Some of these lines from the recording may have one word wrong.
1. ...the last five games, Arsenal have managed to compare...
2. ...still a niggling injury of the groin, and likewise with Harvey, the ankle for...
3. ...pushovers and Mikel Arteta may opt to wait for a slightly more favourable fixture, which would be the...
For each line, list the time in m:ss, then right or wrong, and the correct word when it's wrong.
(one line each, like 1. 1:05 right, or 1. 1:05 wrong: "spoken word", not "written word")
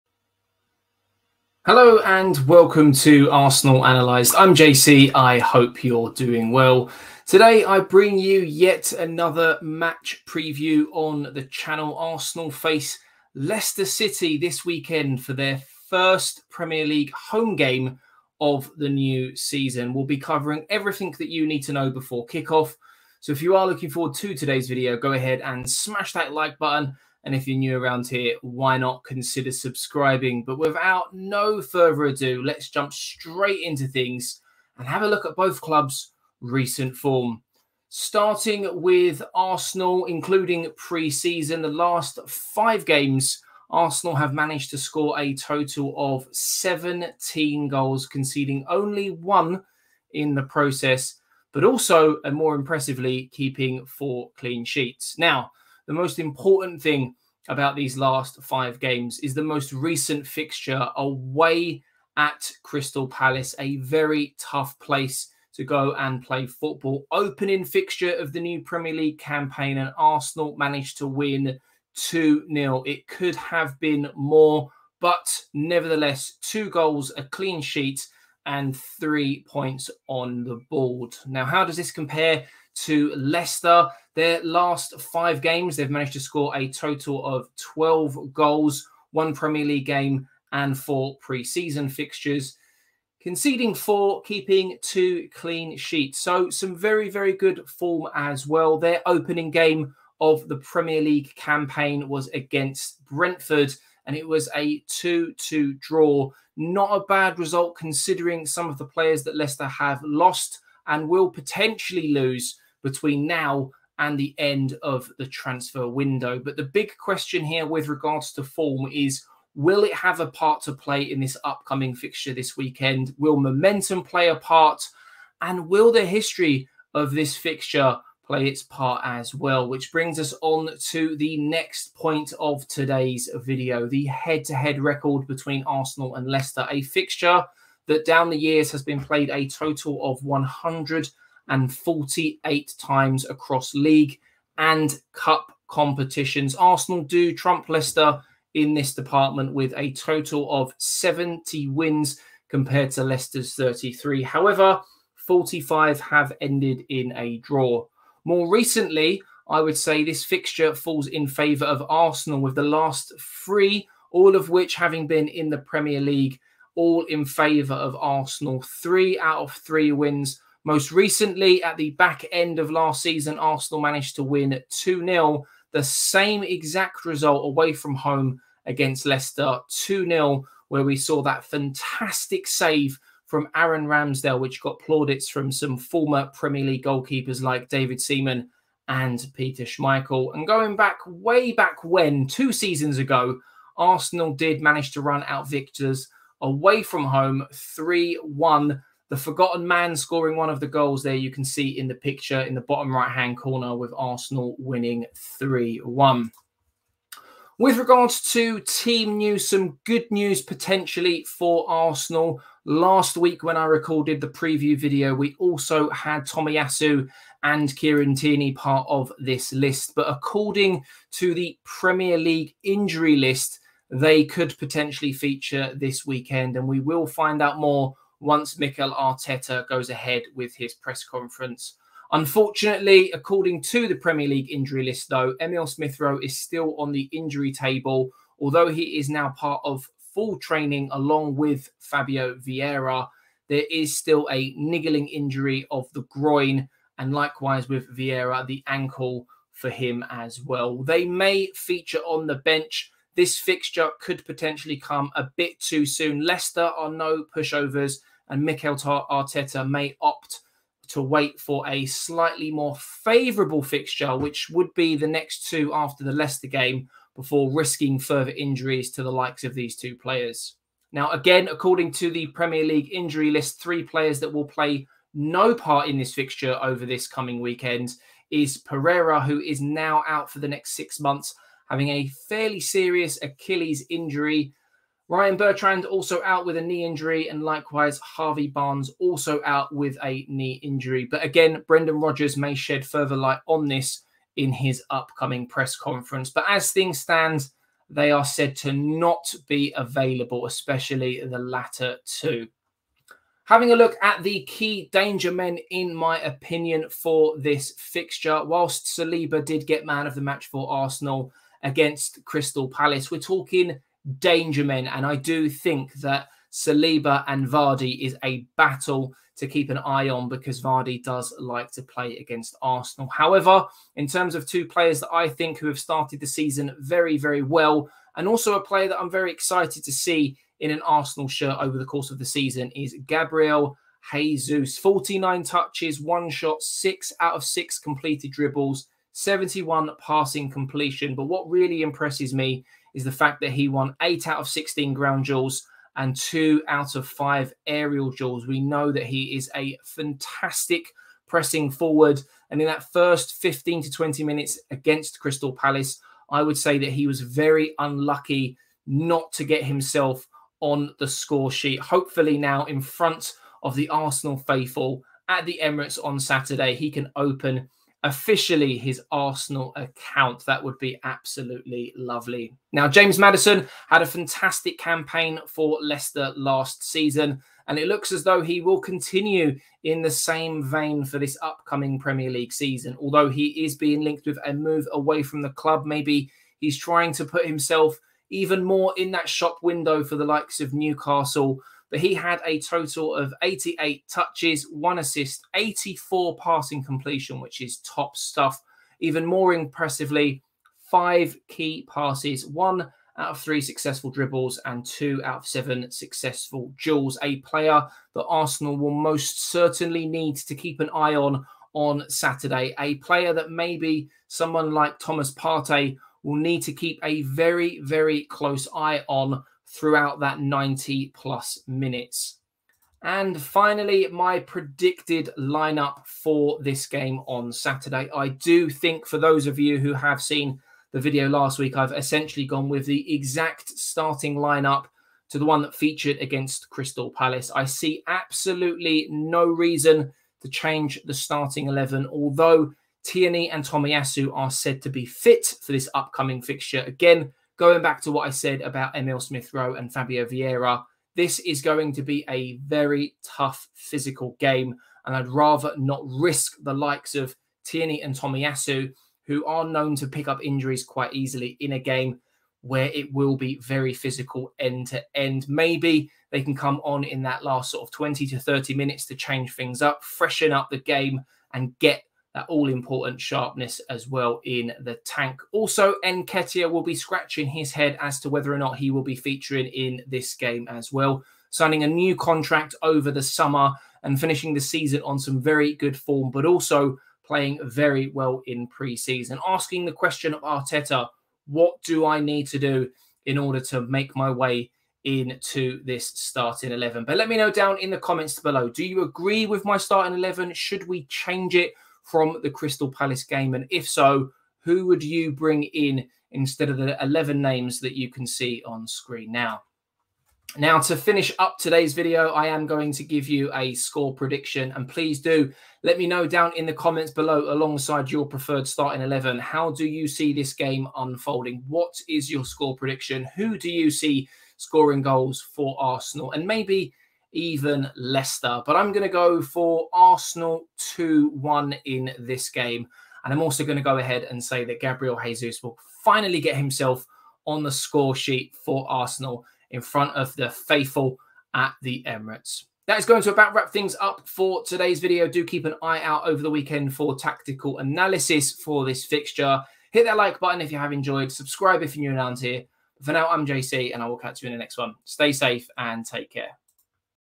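1. 0:41 wrong: "score", not "compare"
2. 4:03 wrong: "Vieira", not "Harvey"
3. 4:17 right.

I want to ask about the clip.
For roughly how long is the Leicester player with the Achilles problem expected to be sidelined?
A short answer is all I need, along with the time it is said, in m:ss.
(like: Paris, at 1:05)
6 months, at 4:40.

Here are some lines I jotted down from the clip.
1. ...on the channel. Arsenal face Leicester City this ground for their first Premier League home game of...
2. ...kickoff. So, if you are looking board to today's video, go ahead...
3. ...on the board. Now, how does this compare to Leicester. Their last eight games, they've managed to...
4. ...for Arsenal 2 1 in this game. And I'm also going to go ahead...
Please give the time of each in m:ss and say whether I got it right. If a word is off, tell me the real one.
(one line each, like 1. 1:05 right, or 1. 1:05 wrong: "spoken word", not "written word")
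1. 0:10 wrong: "weekend", not "ground"
2. 0:22 wrong: "forward", not "board"
3. 1:20 wrong: "five", not "eight"
4. 8:49 right.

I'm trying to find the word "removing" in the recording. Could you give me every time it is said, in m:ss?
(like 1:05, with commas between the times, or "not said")
not said.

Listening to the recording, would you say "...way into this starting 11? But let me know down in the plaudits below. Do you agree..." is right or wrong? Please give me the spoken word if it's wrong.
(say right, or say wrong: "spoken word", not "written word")
wrong: "comments", not "plaudits".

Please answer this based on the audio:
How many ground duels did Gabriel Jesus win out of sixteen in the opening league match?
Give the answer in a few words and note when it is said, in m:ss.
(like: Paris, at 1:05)
8, at 5:44.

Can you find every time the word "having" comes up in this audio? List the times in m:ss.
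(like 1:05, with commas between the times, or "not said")
2:44, 4:41, 5:03.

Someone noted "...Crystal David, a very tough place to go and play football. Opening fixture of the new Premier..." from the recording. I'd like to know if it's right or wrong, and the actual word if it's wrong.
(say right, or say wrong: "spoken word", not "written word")
wrong: "Palace", not "David".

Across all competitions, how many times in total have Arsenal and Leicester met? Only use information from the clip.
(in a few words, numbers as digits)
148.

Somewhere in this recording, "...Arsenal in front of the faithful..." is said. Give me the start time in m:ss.
8:58.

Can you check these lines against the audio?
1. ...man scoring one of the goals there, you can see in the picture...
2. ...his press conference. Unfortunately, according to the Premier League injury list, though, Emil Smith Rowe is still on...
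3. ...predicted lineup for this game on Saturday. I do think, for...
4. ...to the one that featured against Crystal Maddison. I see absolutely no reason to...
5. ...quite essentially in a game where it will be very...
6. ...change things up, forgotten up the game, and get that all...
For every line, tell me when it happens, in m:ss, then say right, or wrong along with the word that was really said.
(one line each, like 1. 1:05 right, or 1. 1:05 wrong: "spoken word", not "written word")
1. 3:19 right
2. 3:50 right
3. 7:04 right
4. 7:15 wrong: "Palace", not "Maddison"
5. 7:40 wrong: "easily", not "essentially"
6. 7:49 wrong: "freshen", not "forgotten".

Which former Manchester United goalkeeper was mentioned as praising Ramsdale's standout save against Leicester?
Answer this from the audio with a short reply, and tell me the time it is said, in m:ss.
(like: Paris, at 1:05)
Peter Schmeichel, at 3:09.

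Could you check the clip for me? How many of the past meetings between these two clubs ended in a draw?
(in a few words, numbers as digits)
45.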